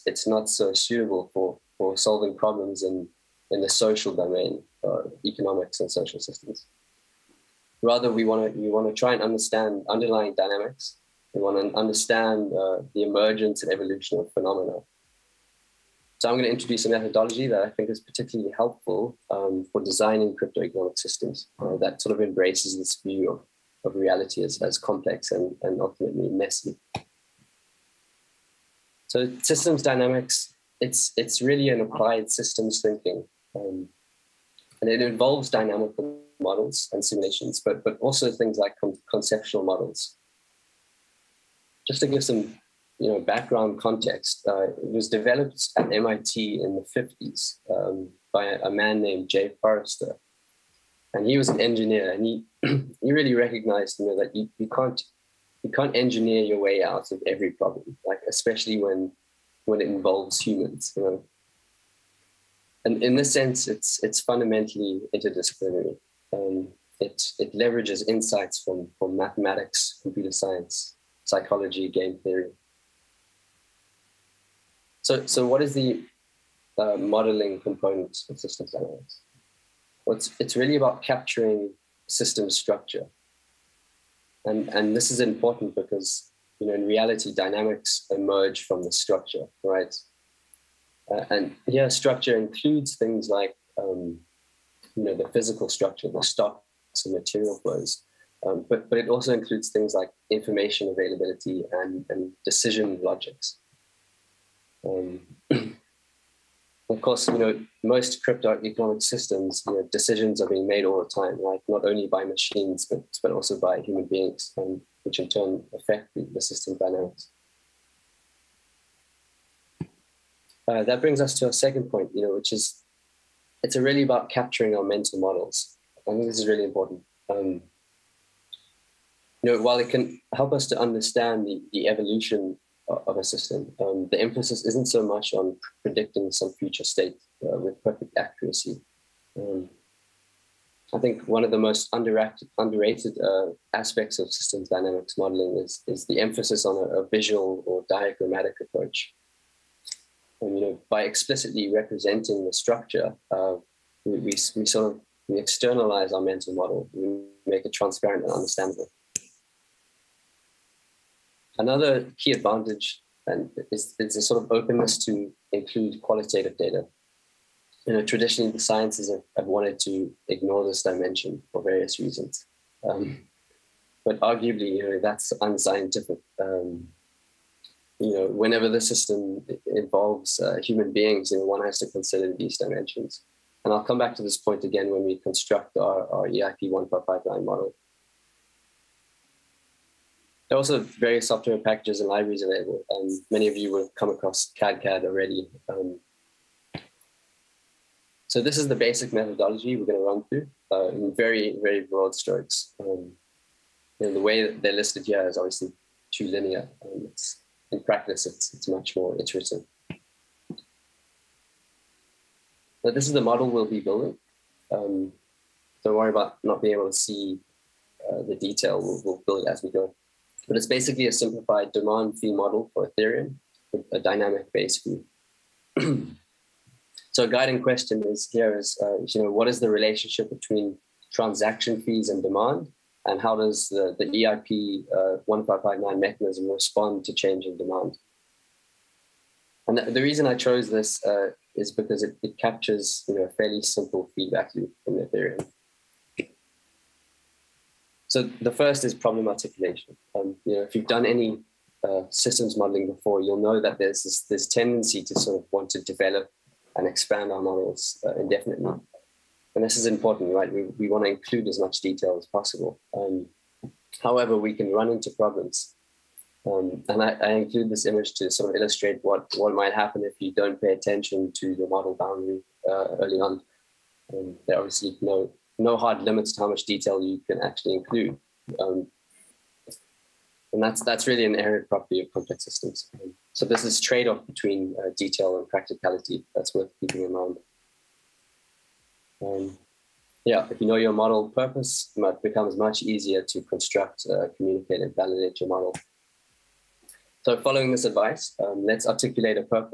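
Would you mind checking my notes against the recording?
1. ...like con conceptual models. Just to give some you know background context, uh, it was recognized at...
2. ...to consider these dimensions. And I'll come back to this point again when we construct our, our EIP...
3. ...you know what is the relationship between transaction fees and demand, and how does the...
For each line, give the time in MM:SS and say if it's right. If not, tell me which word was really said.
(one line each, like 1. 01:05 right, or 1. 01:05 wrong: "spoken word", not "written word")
1. 00:38 wrong: "developed", not "recognized"
2. 03:01 right
3. 03:49 right.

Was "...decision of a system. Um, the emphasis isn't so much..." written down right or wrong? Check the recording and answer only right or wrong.
wrong.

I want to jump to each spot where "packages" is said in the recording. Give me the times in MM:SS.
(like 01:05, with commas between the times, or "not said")
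03:11.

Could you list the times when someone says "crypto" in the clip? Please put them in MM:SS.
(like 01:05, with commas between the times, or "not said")
00:20, 01:48.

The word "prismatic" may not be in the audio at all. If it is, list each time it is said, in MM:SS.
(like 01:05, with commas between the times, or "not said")
not said.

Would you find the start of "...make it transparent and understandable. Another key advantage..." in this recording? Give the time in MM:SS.
02:37.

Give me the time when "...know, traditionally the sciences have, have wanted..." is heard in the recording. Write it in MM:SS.
02:47.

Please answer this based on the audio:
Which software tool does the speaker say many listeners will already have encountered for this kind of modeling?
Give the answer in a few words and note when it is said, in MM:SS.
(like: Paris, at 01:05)
cadCAD, at 03:14.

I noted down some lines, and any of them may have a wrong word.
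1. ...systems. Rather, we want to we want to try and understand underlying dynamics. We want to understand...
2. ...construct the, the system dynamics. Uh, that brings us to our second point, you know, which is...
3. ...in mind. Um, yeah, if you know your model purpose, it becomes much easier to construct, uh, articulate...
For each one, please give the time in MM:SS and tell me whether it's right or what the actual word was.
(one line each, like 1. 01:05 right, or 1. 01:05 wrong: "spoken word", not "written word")
1. 00:06 right
2. 01:55 wrong: "affect", not "construct"
3. 04:47 wrong: "communicate", not "articulate".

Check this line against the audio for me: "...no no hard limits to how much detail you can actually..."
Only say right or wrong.
right.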